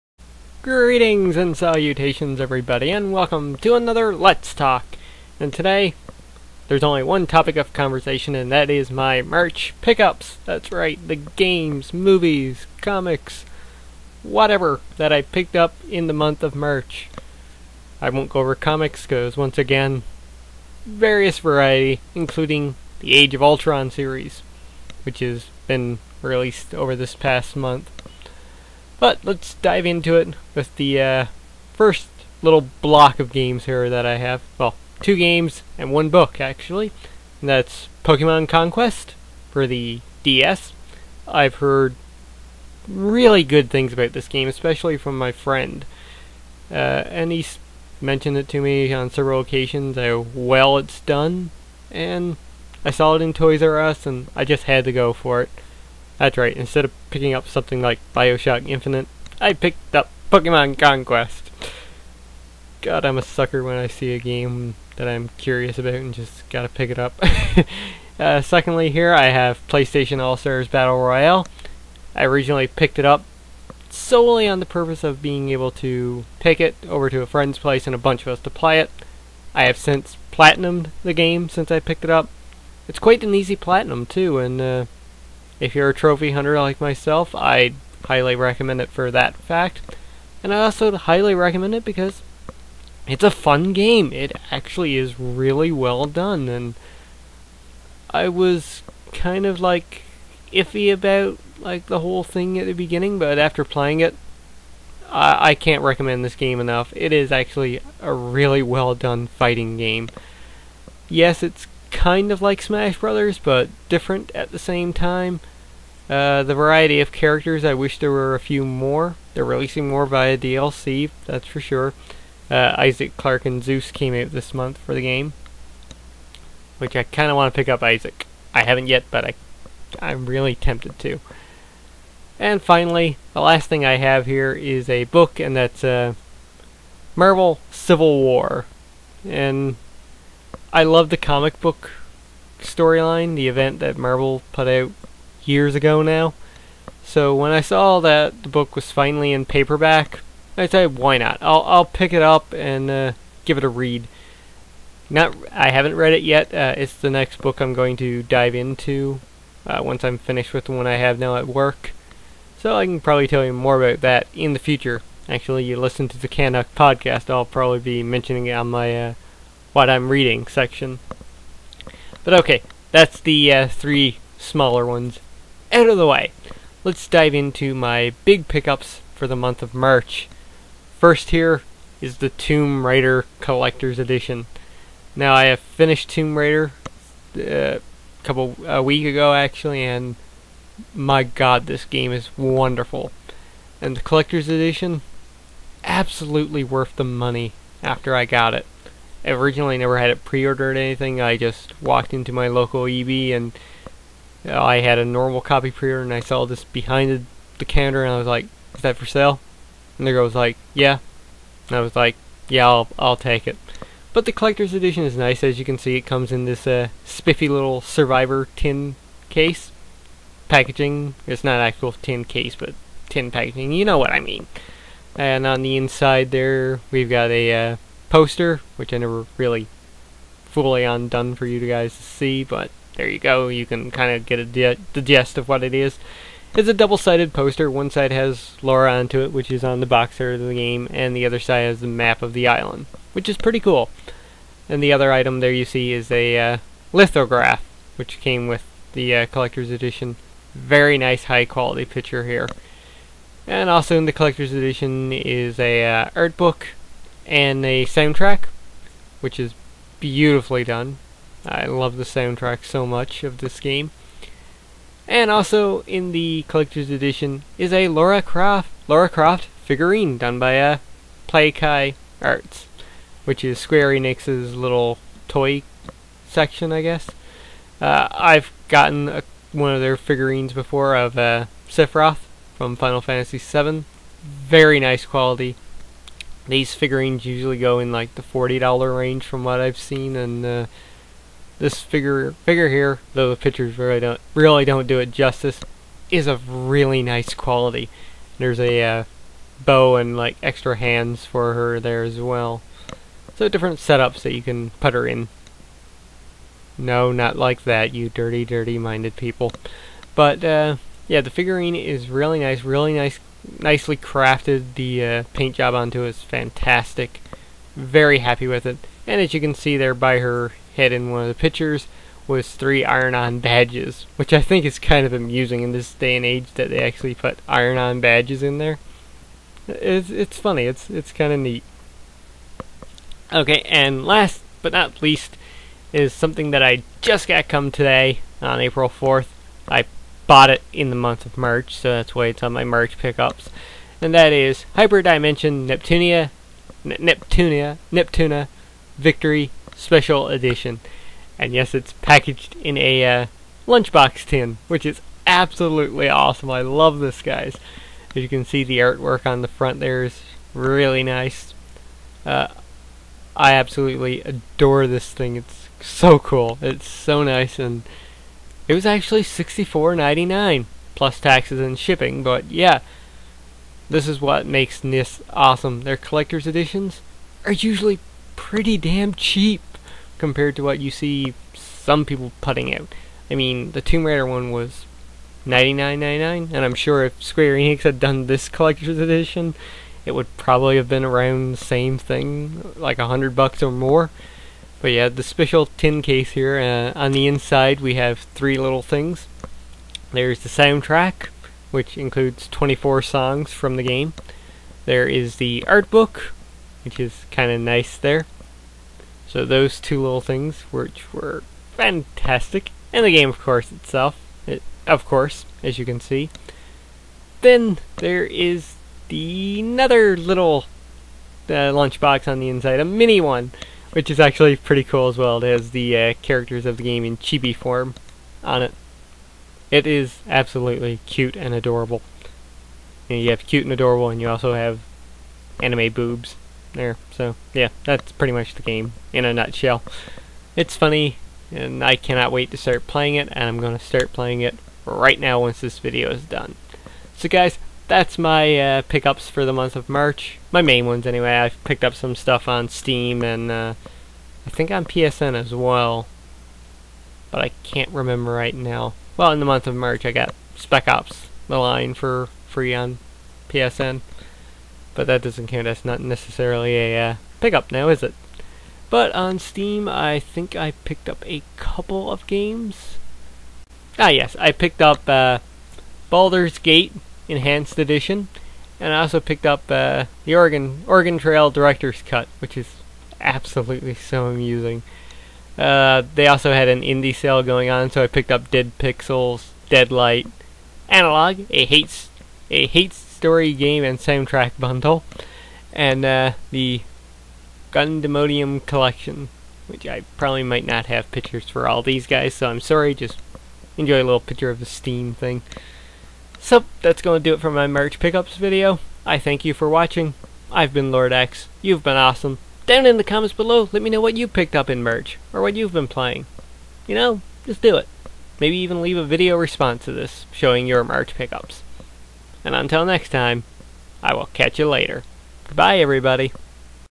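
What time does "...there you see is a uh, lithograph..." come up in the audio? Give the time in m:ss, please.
4:05.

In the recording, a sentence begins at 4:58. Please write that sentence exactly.
There's a uh, bow and like extra hands for her there as well.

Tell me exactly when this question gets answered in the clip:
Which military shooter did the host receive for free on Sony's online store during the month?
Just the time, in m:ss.
7:40.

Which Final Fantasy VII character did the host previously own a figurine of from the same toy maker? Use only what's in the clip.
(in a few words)
Sephiroth.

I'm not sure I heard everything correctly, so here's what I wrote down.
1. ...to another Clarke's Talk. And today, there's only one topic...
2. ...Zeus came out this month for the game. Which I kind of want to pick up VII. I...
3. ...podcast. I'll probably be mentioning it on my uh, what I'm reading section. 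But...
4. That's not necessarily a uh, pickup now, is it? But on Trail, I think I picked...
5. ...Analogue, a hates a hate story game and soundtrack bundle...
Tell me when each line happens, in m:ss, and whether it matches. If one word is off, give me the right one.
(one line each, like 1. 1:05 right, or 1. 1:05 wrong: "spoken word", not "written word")
1. 0:03 wrong: "Let", not "Clarke"
2. 2:03 wrong: "Isaac", not "VII"
3. 2:46 right
4. 7:45 wrong: "Steam", not "Trail"
5. 8:10 right.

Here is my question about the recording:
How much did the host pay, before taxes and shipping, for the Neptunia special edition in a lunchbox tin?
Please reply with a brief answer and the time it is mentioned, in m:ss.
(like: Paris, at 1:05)
$64.99, at 6:09.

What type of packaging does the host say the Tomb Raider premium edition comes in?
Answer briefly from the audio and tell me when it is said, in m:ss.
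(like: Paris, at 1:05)
Survivor tin case, at 3:37.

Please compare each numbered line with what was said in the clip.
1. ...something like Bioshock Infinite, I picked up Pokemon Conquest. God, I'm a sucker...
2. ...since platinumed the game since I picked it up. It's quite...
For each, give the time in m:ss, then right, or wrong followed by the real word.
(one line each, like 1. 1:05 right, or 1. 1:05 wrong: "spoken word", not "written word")
1. 0:57 right
2. 1:19 right.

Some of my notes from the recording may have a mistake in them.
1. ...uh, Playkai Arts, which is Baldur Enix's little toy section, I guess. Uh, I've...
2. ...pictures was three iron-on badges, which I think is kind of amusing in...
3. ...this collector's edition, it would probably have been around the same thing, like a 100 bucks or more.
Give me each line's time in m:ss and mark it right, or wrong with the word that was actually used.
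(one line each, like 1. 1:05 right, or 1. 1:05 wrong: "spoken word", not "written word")
1. 4:30 wrong: "Square", not "Baldur"
2. 5:21 right
3. 6:28 right.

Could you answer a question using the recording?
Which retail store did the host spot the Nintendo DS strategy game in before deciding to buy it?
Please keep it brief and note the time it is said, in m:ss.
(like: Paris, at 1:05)
Toys R Us, at 0:53.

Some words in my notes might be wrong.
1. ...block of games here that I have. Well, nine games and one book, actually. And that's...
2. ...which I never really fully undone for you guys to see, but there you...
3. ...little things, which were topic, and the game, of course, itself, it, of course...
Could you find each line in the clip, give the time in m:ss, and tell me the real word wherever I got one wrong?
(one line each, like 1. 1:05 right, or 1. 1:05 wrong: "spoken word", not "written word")
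1. 0:32 wrong: "two", not "nine"
2. 3:48 right
3. 6:50 wrong: "fantastic", not "topic".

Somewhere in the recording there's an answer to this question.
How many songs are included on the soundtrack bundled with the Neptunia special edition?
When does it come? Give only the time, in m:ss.
6:42.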